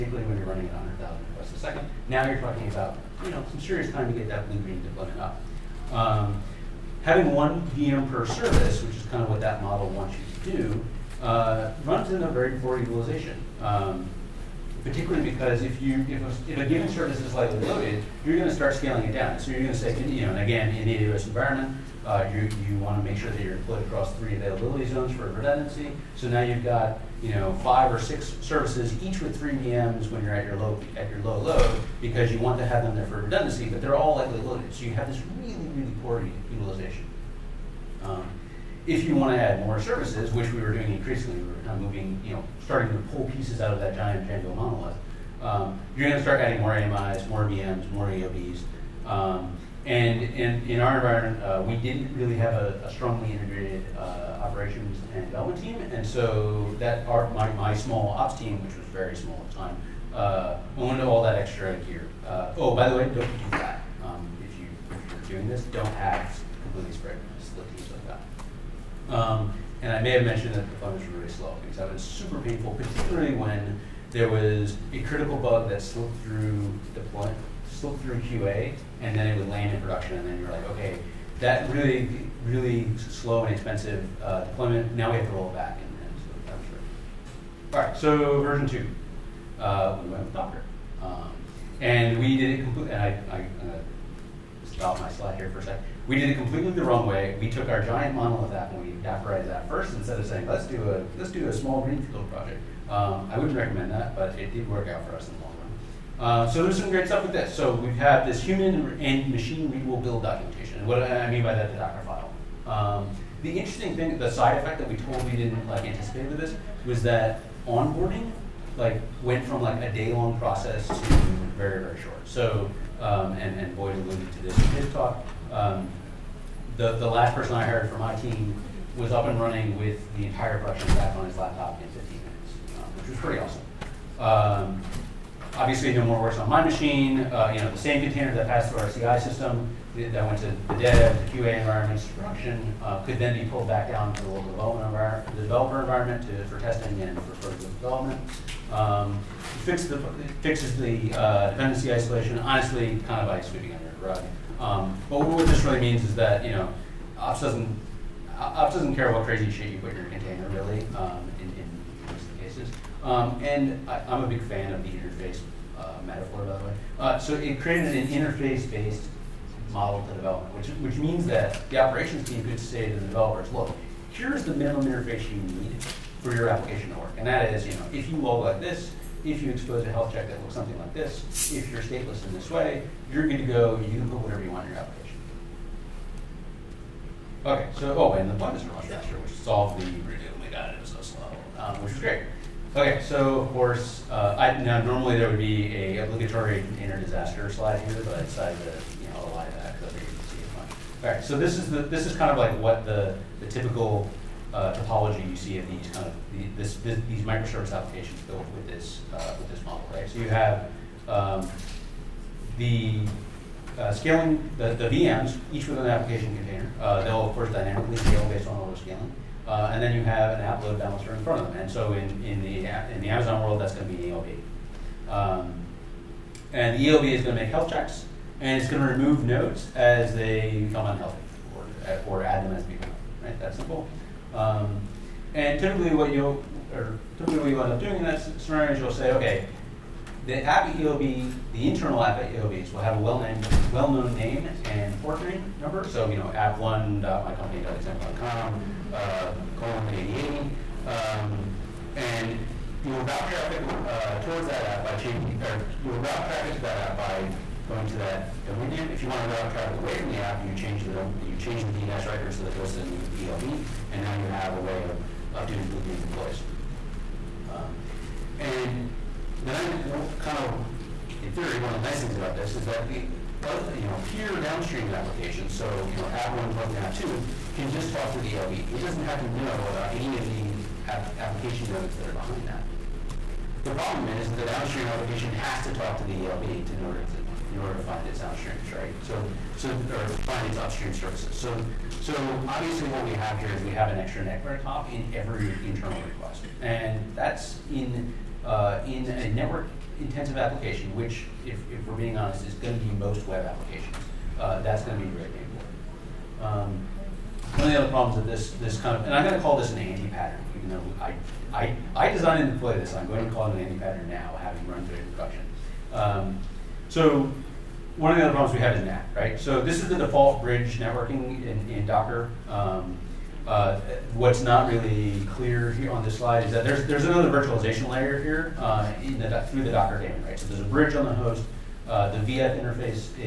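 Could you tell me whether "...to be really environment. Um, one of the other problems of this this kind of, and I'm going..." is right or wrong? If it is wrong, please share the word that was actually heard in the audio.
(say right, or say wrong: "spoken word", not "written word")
wrong: "important", not "environment".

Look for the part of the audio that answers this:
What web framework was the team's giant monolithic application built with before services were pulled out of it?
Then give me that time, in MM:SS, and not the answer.
00:44.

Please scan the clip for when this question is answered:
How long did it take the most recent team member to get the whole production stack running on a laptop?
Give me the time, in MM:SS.
02:11.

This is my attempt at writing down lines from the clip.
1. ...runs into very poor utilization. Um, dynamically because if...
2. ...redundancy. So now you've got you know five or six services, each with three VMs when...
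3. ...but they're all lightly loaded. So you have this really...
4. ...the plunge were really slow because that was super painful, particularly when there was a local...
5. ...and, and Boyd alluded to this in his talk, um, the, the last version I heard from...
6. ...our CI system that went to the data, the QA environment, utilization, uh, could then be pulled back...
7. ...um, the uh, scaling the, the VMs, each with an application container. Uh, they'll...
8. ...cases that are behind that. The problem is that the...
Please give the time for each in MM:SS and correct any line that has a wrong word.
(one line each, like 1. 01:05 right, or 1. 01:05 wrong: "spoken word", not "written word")
1. 00:11 wrong: "particularly", not "dynamically"
2. 00:25 right
3. 00:33 right
4. 01:10 wrong: "critical", not "local"
5. 02:03 wrong: "person", not "version"
6. 02:18 wrong: "production", not "utilization"
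7. 03:31 right
8. 04:41 wrong: "nodes", not "cases".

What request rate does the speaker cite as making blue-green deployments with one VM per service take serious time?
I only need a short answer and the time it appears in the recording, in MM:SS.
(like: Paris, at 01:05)
100,000 requests a second, at 00:00.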